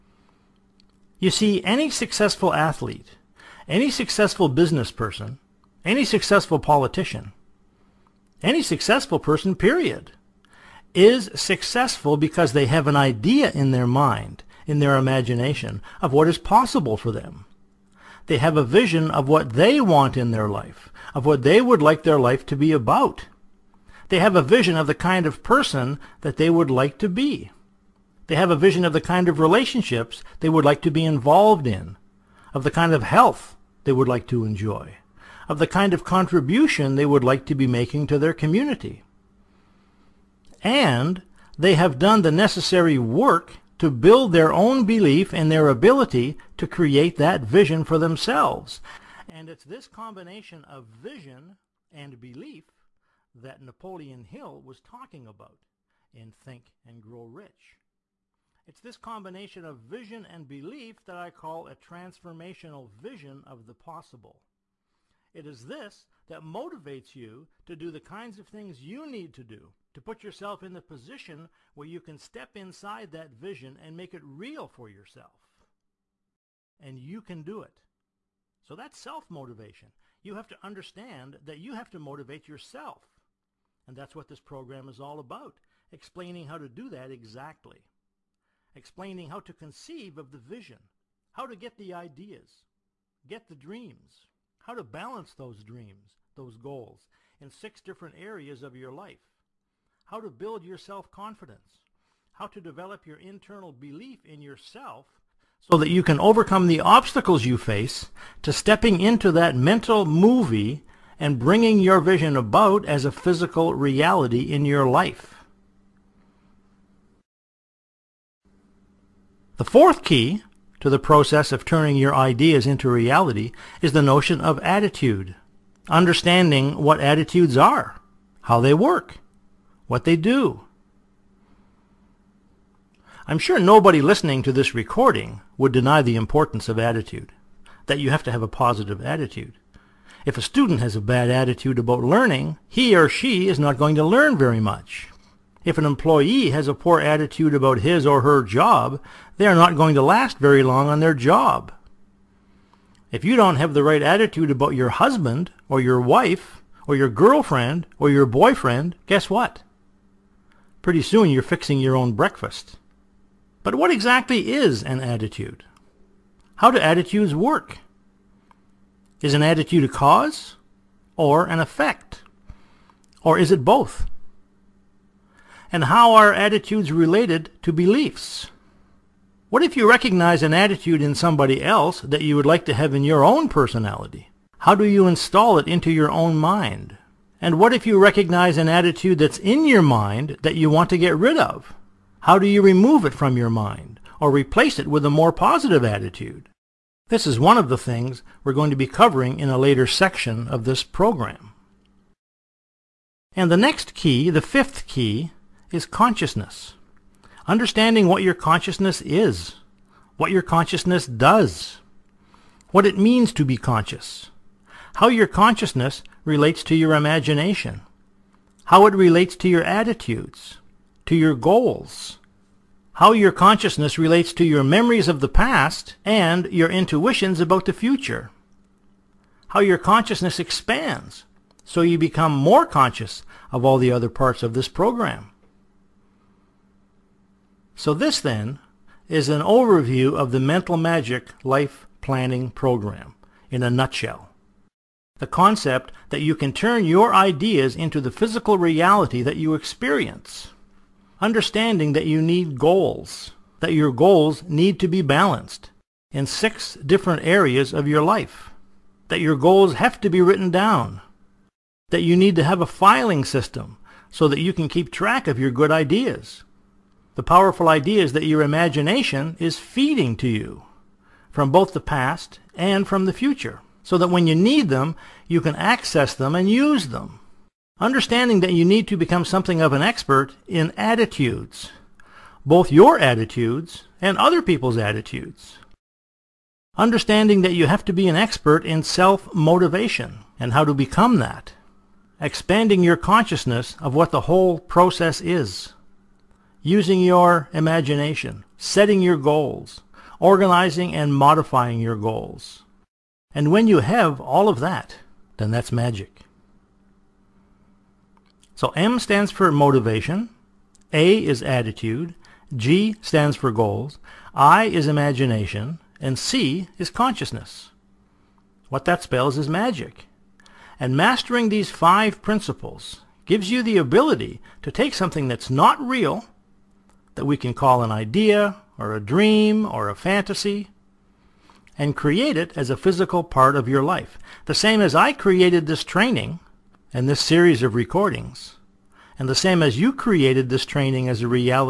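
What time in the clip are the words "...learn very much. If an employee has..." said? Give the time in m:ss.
2:24.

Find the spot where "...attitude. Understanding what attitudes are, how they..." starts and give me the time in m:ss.
2:04.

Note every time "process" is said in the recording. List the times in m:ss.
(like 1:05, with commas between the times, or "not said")
2:00, 4:54.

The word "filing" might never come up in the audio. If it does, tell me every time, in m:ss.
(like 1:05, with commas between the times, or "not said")
4:22.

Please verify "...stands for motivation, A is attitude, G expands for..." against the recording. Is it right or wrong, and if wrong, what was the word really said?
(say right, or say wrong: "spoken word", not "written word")
wrong: "stands", not "expands".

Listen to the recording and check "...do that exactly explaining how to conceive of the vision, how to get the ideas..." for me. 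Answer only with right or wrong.
right.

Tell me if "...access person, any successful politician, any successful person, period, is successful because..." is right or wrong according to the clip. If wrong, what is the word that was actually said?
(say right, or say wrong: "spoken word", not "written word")
wrong: "business", not "access".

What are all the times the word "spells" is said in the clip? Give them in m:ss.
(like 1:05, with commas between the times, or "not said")
5:19.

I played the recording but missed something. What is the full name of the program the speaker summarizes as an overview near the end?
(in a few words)
Mental Magic Life Planning Program.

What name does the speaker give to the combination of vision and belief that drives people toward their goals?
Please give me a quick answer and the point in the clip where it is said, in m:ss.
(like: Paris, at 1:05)
transformational vision of the possible, at 1:01.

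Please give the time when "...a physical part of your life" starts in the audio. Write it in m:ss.
5:32.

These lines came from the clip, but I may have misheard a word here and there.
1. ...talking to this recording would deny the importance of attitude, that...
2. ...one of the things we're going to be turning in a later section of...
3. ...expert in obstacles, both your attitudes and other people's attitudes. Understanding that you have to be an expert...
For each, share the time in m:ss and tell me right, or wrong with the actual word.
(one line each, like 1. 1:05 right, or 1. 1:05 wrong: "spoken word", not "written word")
1. 2:14 wrong: "listening", not "talking"
2. 3:17 wrong: "covering", not "turning"
3. 4:39 wrong: "attitudes", not "obstacles".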